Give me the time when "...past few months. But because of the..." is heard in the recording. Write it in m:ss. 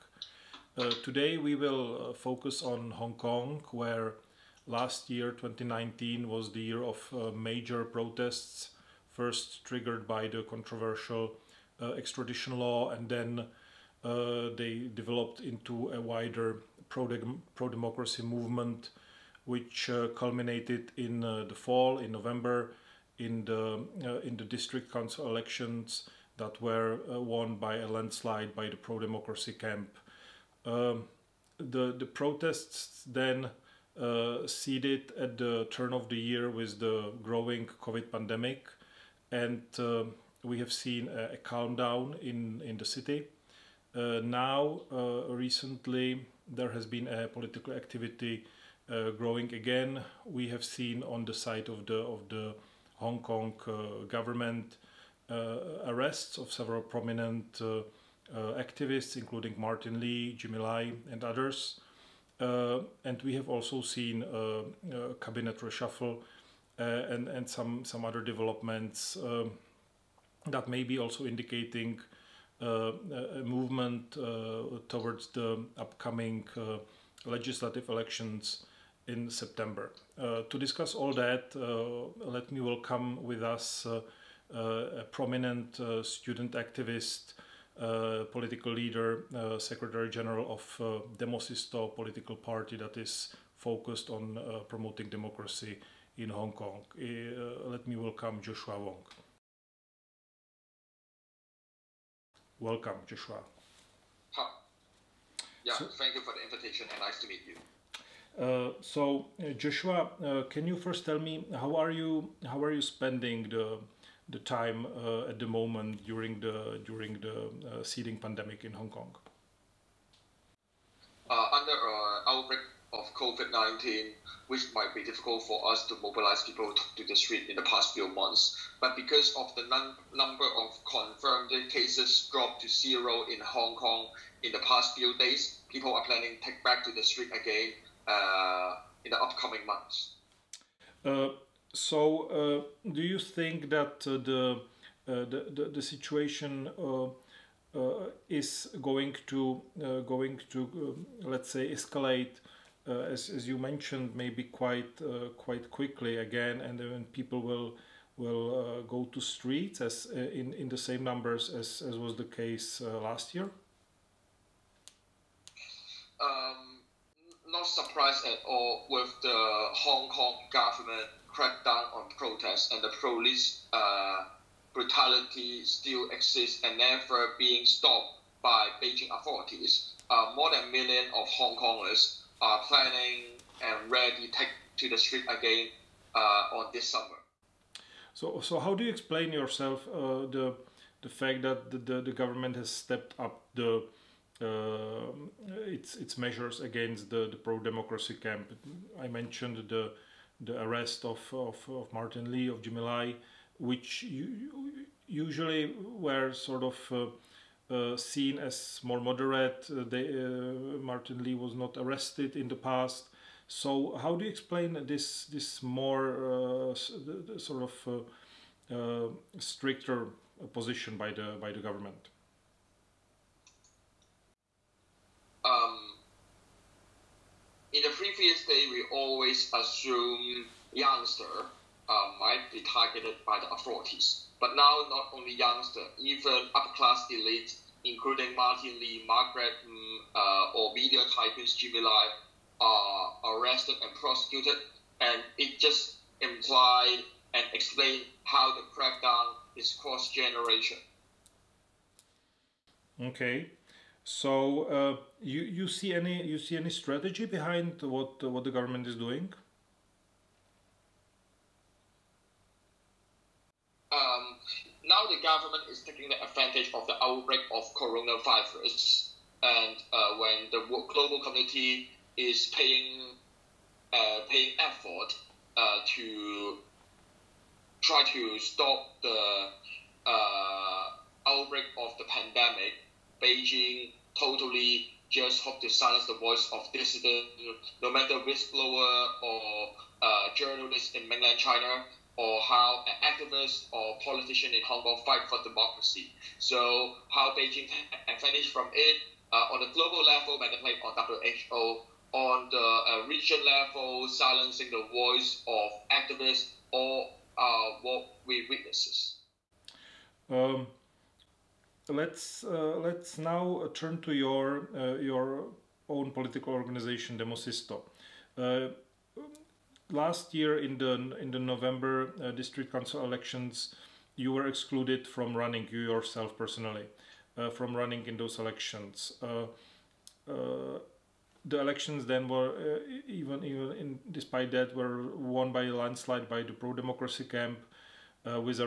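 2:07.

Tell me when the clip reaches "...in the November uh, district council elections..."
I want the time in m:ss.
5:21.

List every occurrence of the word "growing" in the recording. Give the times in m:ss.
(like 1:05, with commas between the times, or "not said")
0:37, 0:49.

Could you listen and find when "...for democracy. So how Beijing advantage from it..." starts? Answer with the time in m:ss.
4:55.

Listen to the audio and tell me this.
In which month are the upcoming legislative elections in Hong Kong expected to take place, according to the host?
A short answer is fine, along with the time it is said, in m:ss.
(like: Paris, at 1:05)
September, at 1:19.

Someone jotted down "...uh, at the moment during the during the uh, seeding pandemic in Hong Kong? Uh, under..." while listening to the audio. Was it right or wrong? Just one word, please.
right.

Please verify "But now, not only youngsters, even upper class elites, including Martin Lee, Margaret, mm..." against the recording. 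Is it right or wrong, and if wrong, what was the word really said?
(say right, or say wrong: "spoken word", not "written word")
right.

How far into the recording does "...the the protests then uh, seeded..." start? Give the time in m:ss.
0:31.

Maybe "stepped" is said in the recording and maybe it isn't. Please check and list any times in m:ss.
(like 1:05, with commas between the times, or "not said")
3:12.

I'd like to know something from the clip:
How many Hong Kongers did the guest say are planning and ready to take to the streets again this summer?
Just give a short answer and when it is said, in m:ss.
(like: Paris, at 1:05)
More than a million, at 3:00.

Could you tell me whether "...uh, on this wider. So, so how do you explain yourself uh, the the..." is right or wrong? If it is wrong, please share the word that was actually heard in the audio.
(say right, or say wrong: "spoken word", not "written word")
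wrong: "summer", not "wider".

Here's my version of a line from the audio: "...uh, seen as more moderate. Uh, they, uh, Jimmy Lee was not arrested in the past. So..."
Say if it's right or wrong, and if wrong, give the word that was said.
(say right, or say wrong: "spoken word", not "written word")
wrong: "Martin", not "Jimmy".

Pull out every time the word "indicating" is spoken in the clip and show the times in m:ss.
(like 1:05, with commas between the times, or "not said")
1:11.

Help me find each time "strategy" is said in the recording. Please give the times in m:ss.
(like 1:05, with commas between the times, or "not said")
4:16.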